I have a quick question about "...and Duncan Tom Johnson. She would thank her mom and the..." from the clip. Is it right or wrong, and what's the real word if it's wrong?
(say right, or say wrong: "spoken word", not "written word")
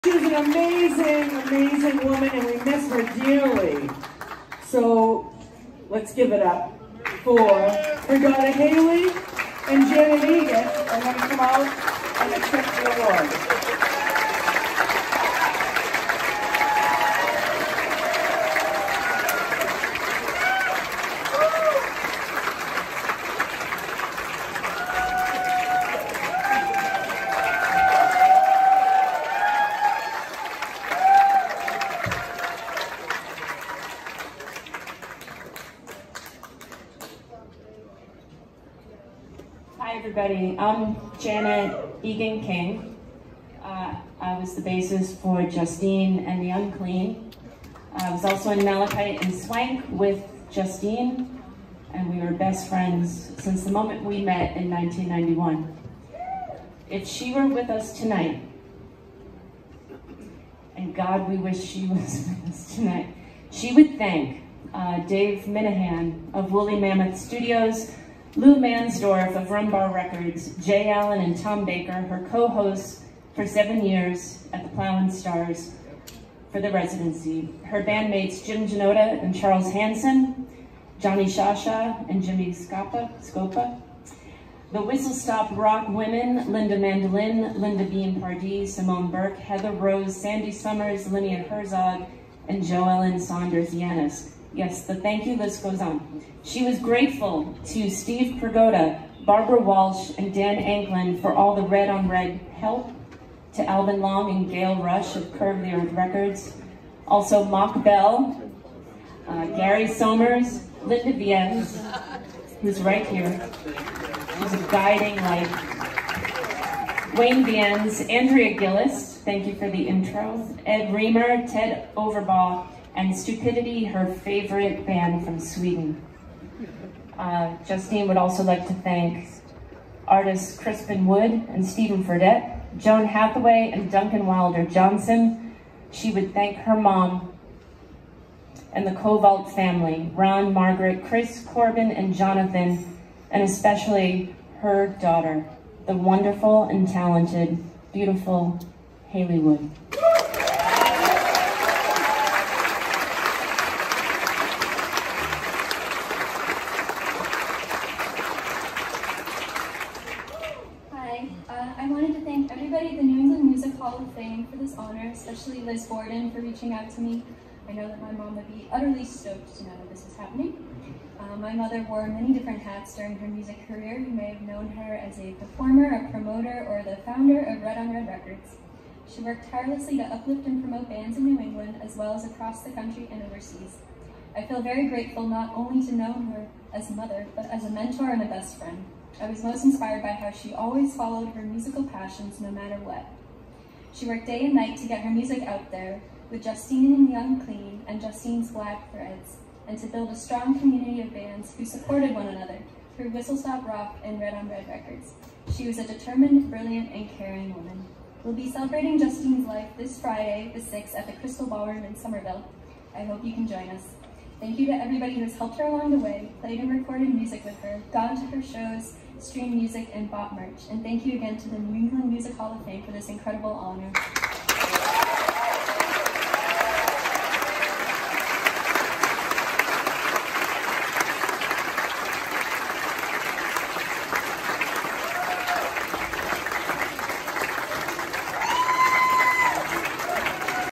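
wrong: "Wilder", not "Tom".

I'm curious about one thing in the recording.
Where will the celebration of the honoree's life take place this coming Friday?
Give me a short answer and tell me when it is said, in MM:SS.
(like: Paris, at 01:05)
Crystal Ballroom, at 03:31.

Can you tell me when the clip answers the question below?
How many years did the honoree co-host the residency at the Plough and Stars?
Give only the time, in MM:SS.
01:13.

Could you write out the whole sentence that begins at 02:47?
I know that my mom would be utterly stoked to know that this is happening.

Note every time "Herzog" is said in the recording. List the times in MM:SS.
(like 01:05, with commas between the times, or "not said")
01:31.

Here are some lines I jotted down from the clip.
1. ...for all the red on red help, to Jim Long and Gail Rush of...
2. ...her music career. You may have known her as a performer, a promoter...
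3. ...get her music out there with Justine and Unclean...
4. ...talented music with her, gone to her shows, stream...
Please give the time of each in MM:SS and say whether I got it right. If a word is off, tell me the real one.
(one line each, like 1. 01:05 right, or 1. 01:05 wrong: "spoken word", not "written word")
1. 01:41 wrong: "Alvin", not "Jim"
2. 02:53 right
3. 03:14 right
4. 03:36 wrong: "recorded", not "talented".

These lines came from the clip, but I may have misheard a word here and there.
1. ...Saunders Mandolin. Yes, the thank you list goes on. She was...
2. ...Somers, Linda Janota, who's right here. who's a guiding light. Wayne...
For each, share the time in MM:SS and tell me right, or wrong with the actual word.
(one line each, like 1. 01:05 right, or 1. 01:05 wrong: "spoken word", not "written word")
1. 01:33 wrong: "Yanis", not "Mandolin"
2. 01:49 wrong: "Vienz", not "Janota".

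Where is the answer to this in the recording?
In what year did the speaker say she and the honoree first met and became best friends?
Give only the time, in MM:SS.
00:54.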